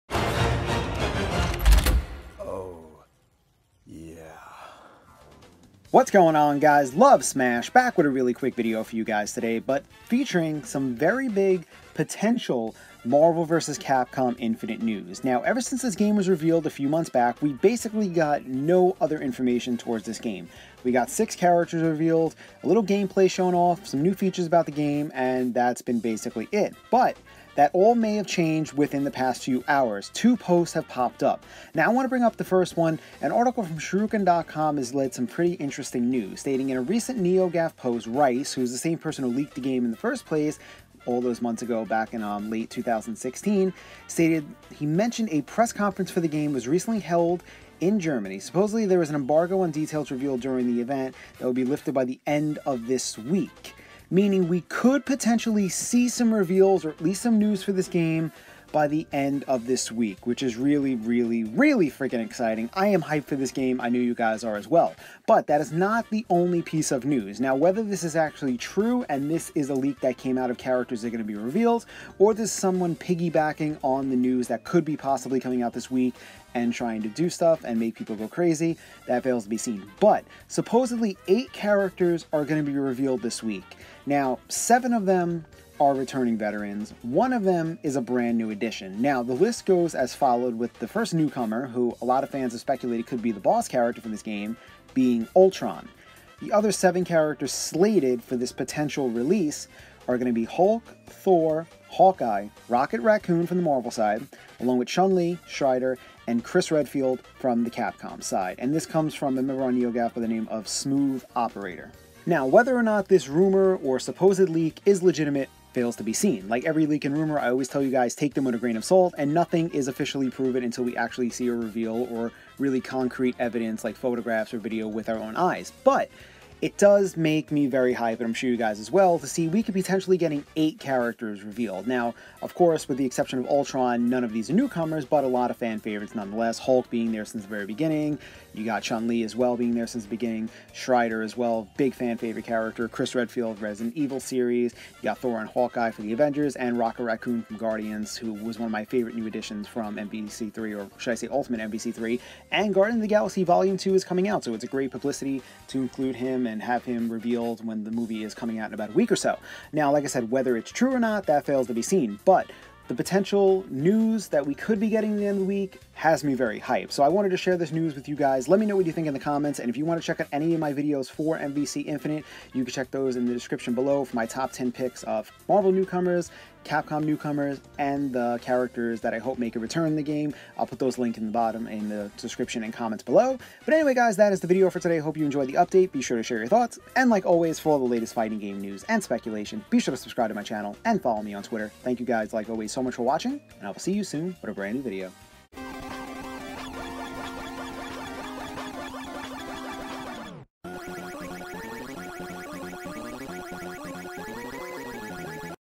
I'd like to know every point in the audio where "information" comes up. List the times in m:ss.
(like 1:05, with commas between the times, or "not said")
0:19.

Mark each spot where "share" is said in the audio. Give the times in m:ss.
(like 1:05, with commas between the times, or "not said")
2:47, 3:06.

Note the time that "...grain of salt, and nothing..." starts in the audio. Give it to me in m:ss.
1:58.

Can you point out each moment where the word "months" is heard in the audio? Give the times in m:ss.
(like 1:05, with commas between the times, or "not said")
0:16, 0:41.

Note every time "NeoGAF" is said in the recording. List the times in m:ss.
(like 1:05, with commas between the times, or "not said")
0:37, 1:49.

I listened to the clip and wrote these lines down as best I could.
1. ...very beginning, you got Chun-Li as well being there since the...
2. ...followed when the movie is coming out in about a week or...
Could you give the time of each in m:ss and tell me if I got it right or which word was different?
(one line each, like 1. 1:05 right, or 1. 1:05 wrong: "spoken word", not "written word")
1. 2:17 right
2. 2:37 wrong: "revealed", not "followed".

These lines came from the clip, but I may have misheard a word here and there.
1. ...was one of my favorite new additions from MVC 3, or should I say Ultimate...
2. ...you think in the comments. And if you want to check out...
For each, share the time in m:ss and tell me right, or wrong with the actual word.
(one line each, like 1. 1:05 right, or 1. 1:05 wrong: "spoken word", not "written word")
1. 2:28 right
2. 2:48 right.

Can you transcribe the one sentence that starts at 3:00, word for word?
I'll put those links in the bottom in the description and comments below.